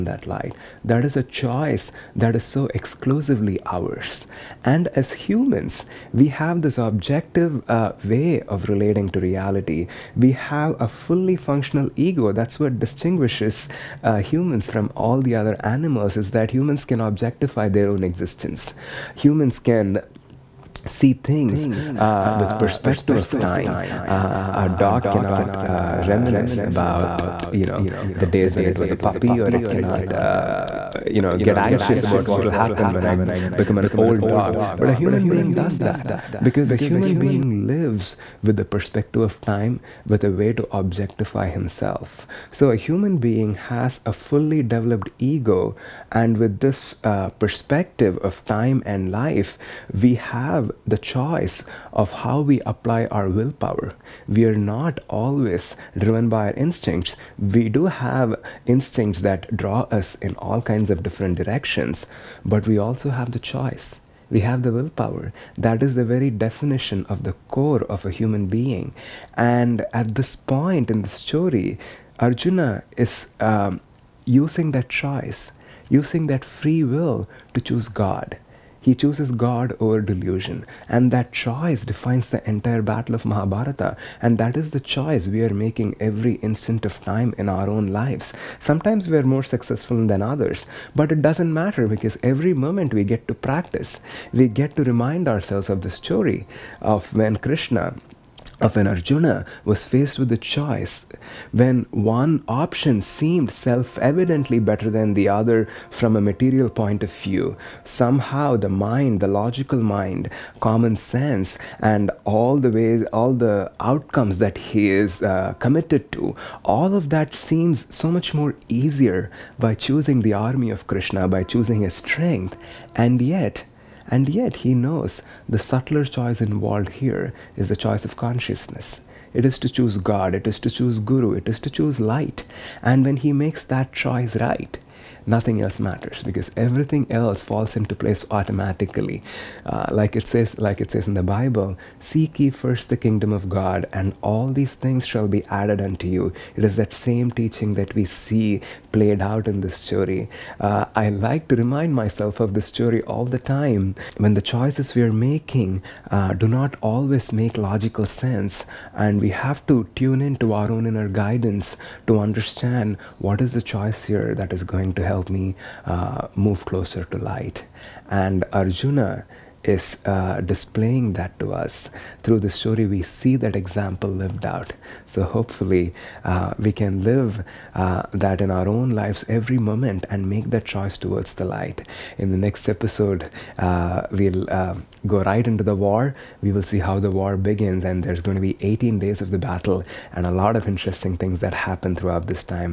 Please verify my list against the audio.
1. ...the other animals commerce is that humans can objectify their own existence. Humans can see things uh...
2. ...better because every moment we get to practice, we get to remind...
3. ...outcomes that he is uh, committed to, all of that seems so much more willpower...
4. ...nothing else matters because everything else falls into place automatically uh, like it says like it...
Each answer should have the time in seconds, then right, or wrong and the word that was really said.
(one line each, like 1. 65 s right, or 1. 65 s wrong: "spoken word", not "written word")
1. 15 s right
2. 91 s wrong: "matter", not "better"
3. 113 s wrong: "easier", not "willpower"
4. 135 s right.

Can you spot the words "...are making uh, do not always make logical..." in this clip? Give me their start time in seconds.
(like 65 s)
155 s.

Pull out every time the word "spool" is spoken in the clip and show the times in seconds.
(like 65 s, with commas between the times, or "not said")
not said.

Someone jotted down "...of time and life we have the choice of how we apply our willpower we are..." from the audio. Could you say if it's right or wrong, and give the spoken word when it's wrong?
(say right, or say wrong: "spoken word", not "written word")
right.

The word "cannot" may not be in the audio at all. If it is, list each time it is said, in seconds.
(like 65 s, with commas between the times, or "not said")
25 s, 29 s.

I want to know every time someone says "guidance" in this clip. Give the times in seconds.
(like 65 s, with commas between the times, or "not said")
161 s.